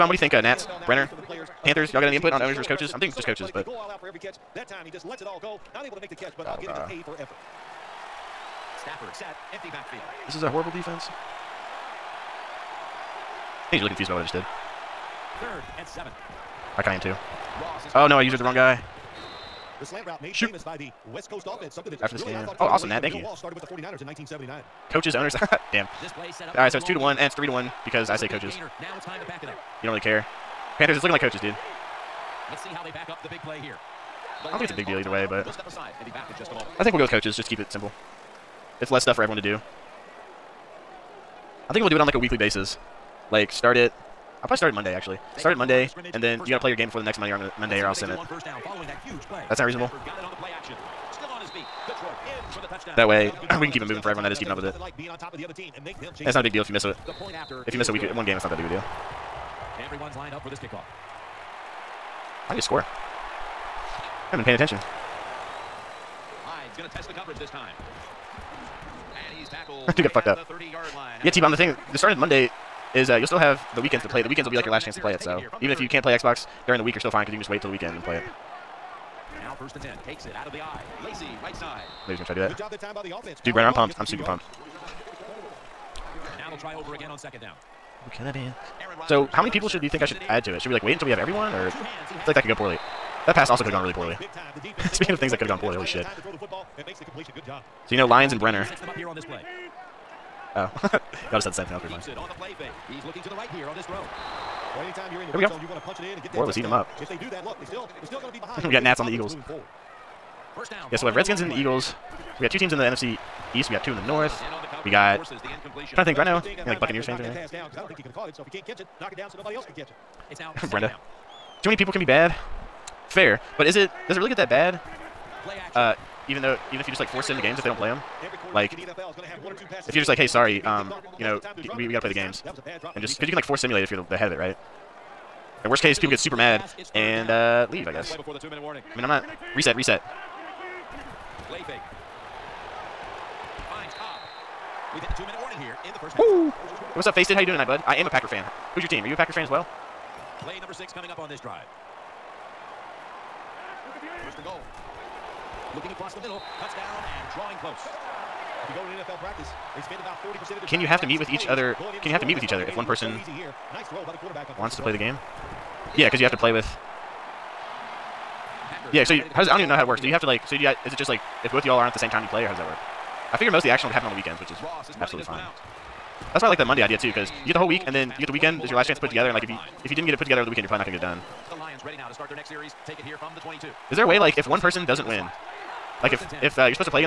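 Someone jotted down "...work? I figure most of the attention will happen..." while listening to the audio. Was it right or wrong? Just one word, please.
wrong.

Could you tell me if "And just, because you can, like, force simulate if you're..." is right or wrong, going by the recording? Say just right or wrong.
right.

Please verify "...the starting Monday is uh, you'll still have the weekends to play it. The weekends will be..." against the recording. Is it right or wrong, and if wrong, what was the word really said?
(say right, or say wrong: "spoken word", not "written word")
right.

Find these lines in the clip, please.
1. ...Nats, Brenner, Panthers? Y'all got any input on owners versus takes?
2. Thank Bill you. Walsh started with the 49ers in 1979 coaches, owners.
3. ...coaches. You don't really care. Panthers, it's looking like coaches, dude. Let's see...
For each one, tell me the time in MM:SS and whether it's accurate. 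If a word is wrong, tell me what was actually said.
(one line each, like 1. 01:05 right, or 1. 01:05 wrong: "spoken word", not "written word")
1. 00:00 wrong: "coaches", not "takes"
2. 00:23 right
3. 00:28 right.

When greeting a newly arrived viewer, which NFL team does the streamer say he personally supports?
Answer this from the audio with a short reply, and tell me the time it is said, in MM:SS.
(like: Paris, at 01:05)
Packers, at 02:28.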